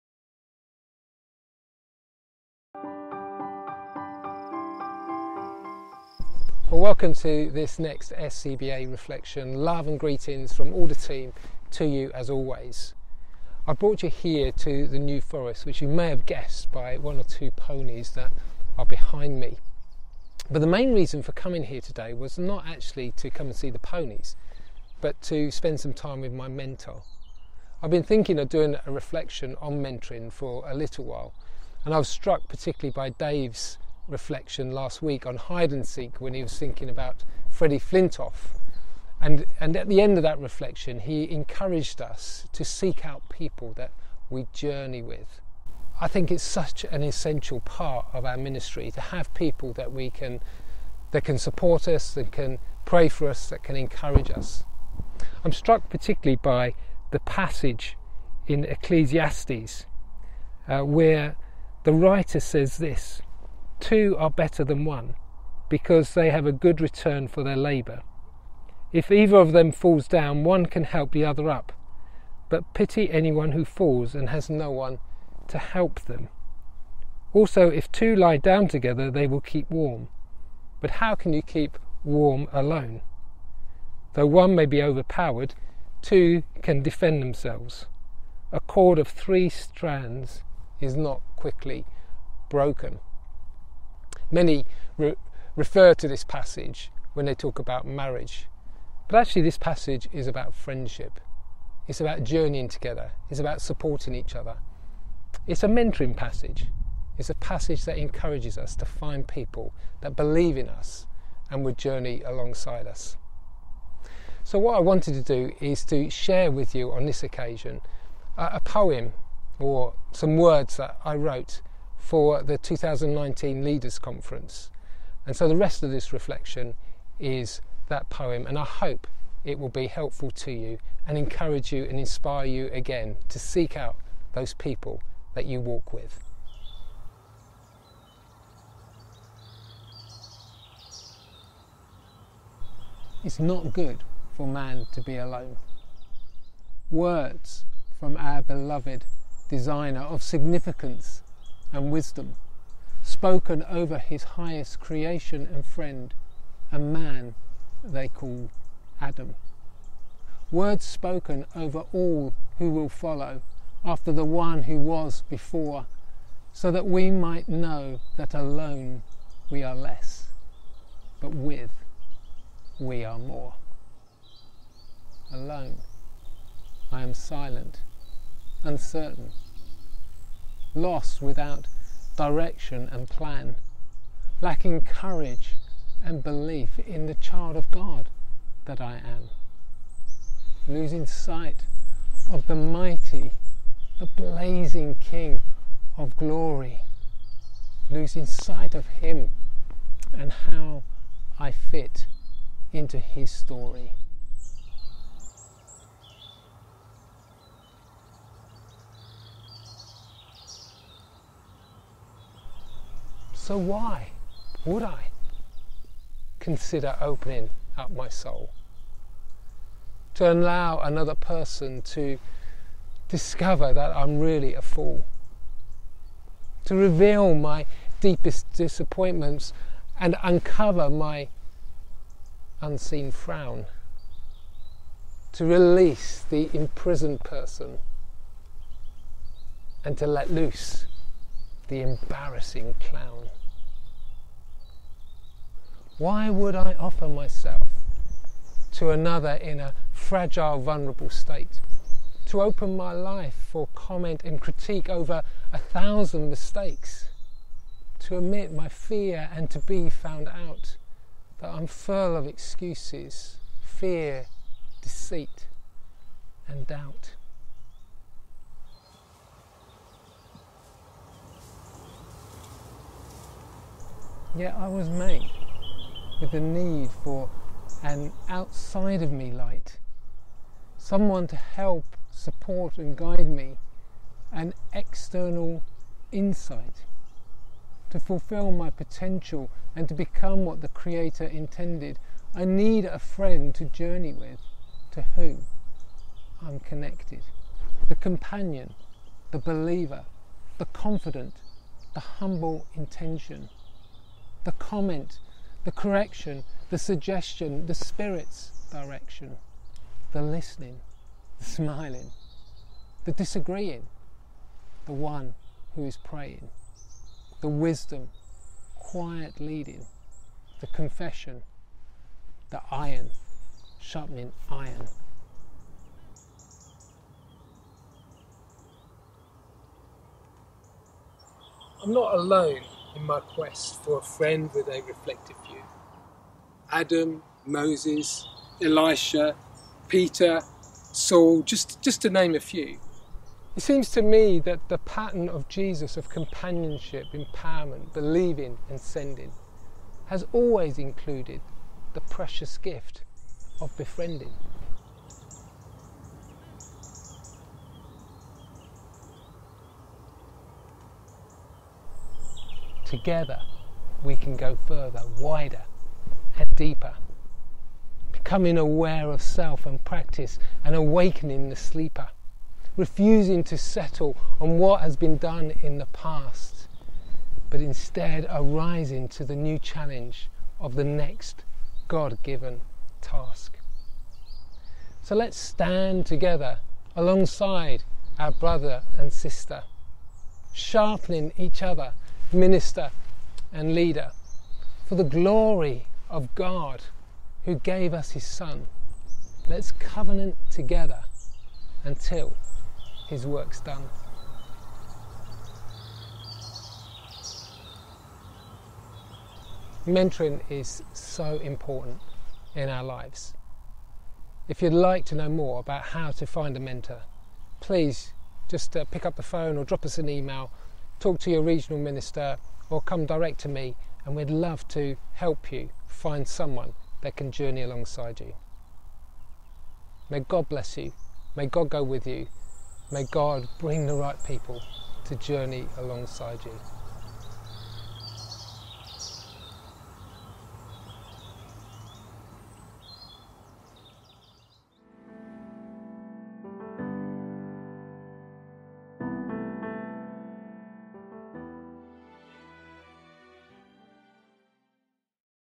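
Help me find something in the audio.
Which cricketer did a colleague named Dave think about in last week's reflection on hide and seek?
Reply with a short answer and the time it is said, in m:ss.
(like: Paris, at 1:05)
Freddie Flintoff, at 0:37.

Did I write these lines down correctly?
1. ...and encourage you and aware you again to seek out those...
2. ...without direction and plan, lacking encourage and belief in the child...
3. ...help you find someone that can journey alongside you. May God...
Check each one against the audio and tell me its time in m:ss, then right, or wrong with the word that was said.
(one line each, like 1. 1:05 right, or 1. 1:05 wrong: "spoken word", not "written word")
1. 2:11 wrong: "inspire", not "aware"
2. 3:01 wrong: "courage", not "encourage"
3. 7:05 right.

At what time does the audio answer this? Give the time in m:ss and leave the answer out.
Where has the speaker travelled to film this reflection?
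0:14.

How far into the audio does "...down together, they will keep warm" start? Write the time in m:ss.
1:18.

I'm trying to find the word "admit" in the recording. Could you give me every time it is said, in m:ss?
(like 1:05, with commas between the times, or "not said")
4:18.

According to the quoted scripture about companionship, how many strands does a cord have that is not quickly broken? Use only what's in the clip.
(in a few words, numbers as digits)
3.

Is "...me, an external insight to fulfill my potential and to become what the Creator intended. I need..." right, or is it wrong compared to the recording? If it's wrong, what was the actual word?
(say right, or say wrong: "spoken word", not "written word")
right.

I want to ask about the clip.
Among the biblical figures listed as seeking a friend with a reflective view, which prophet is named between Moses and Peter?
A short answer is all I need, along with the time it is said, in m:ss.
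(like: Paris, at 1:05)
Elisha, at 5:38.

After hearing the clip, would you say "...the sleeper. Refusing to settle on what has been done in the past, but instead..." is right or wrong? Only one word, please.
right.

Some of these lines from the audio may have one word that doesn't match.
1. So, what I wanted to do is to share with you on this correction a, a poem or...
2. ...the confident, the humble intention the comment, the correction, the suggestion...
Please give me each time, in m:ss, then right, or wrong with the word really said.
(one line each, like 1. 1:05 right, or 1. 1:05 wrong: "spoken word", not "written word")
1. 1:54 wrong: "occasion", not "correction"
2. 5:00 right.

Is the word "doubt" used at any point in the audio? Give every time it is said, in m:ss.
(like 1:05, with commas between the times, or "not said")
4:26.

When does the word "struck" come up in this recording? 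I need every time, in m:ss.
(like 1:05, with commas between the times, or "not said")
0:32, 0:55.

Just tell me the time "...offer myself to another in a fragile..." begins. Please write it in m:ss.
4:06.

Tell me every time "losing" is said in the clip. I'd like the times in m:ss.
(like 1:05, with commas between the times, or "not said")
3:10, 3:17.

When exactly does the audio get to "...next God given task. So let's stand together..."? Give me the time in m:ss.
6:20.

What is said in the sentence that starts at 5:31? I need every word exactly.
I'm not alone in my quest for a friend with a reflective view.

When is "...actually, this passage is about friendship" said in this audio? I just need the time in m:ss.
1:39.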